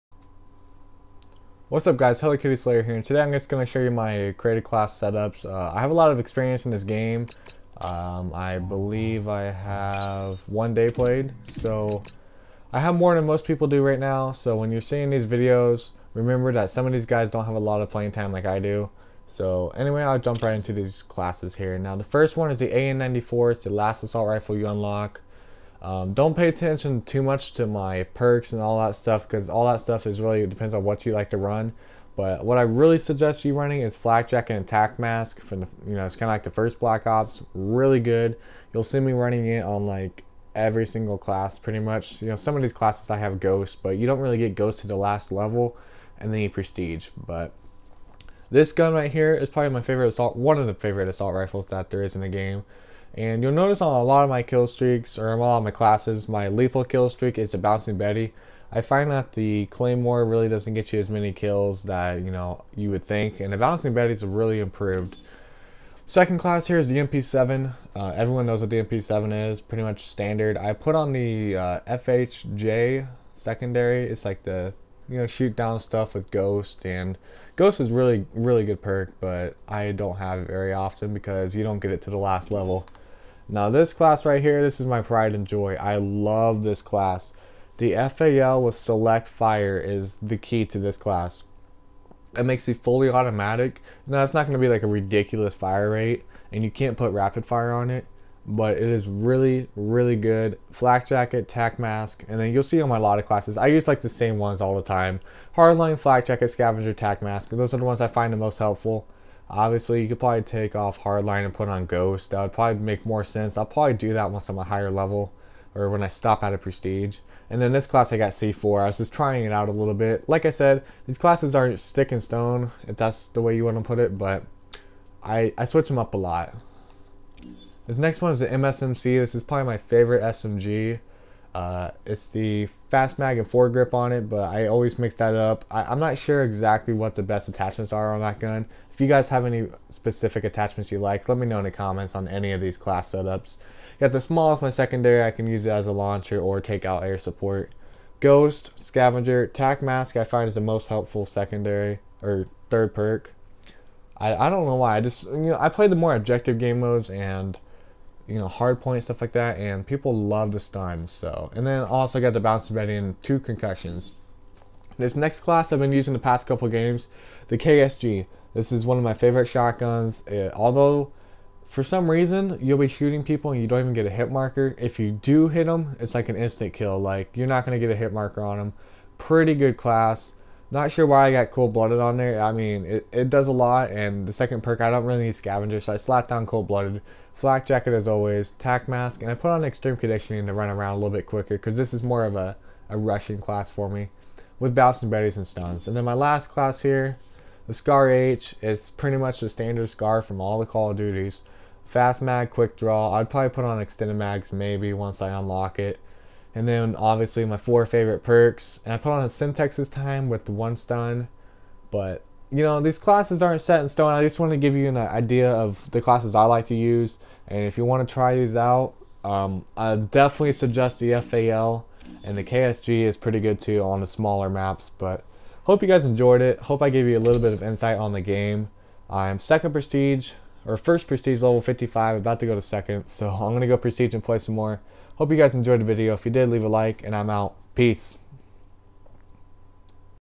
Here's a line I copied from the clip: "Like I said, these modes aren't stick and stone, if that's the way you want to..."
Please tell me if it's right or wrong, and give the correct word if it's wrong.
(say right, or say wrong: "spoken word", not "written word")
wrong: "classes", not "modes".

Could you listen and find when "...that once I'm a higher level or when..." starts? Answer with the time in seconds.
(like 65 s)
114 s.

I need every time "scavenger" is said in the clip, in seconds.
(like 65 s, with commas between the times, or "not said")
106 s, 148 s, 185 s.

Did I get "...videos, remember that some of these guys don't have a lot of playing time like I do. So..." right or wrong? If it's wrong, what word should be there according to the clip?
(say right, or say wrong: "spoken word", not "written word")
right.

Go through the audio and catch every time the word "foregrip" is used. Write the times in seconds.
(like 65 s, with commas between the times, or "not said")
133 s.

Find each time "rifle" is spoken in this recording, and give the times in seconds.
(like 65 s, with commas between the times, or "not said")
24 s, 51 s.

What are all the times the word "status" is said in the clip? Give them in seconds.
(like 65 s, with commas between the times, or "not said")
not said.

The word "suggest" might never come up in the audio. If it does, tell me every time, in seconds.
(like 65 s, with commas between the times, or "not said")
32 s, 220 s.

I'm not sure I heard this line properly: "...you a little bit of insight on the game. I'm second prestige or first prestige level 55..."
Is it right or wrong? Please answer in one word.
right.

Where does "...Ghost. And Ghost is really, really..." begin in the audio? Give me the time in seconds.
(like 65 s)
76 s.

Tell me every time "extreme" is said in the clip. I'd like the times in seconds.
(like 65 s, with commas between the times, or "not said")
189 s.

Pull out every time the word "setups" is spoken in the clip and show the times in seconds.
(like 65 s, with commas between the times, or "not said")
4 s, 143 s.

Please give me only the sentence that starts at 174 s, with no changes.
If you do hit them, it's like an instant kill, like you're not going to get a hit marker on them.